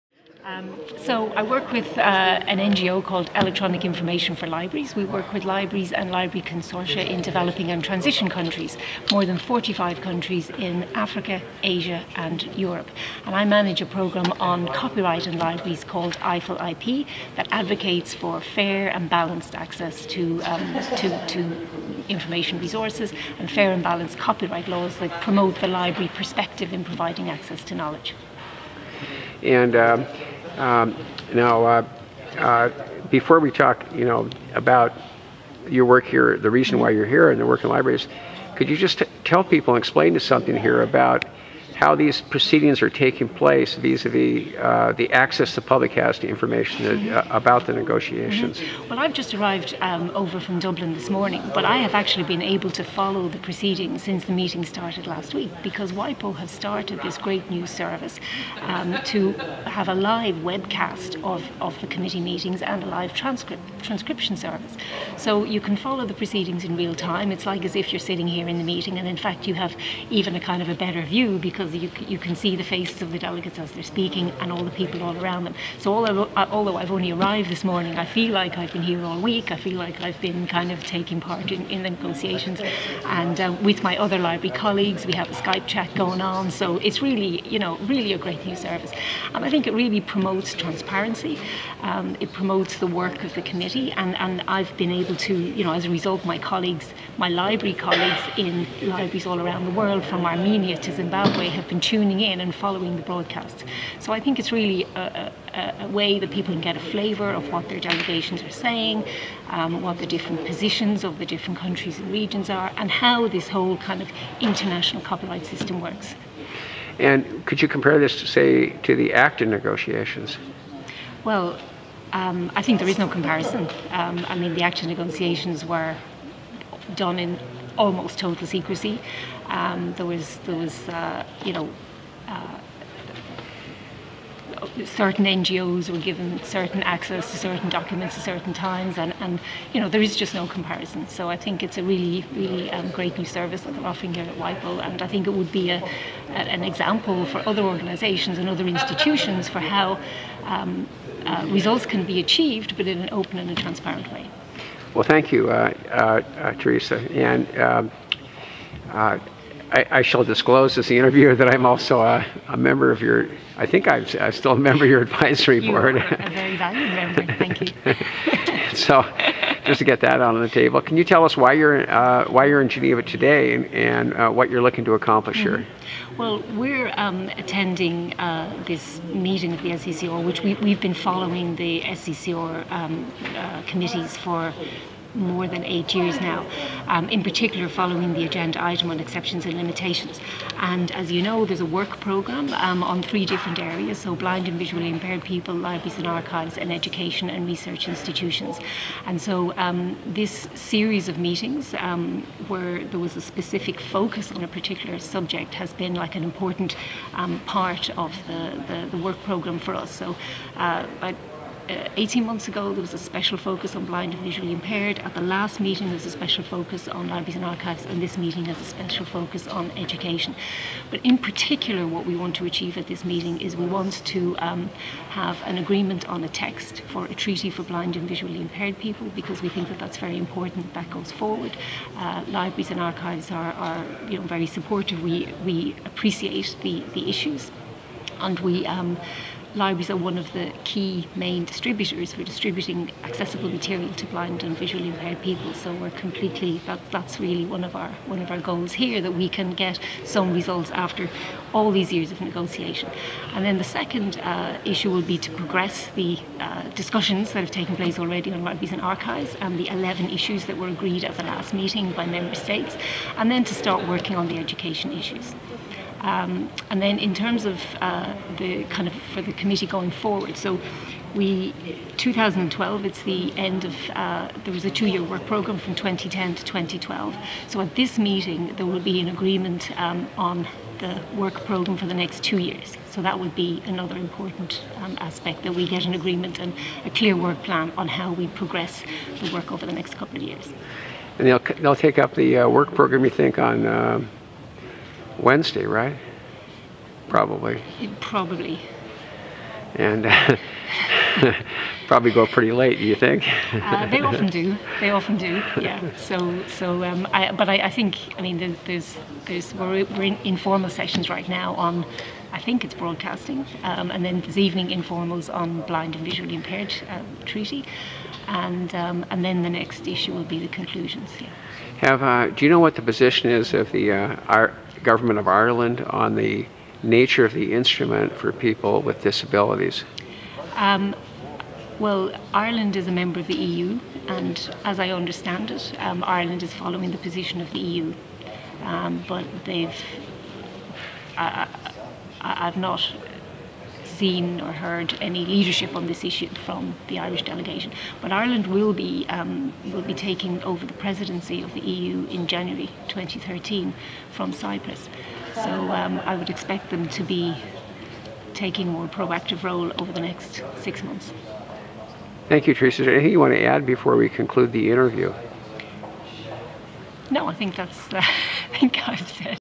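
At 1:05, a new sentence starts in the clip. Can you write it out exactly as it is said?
So you can follow the proceedings in real time.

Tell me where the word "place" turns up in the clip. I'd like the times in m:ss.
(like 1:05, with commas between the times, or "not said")
0:43, 4:17.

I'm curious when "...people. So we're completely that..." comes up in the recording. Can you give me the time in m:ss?
4:05.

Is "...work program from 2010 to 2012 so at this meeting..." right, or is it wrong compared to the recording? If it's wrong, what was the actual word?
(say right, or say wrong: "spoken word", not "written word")
right.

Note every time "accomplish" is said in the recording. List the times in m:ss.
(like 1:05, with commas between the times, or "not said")
2:54.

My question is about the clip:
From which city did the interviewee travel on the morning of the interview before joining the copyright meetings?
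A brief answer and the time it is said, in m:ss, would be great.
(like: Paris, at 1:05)
Dublin, at 0:50.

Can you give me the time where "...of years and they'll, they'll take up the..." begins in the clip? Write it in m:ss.
4:50.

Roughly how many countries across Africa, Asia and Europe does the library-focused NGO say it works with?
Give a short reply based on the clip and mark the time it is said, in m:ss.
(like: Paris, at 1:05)
more than 45, at 0:09.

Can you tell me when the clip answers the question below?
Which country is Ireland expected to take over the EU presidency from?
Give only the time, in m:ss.
5:54.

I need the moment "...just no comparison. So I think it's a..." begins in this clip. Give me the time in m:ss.
2:20.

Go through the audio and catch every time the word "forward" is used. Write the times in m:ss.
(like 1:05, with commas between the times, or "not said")
3:51, 4:29.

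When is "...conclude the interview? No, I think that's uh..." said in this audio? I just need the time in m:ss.
6:04.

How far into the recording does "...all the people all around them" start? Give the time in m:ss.
1:14.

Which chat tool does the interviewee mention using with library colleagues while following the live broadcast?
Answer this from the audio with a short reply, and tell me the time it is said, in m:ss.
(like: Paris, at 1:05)
Skype, at 1:25.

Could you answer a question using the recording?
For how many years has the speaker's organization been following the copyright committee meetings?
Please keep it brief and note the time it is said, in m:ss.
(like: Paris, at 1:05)
more than 8 years, at 3:05.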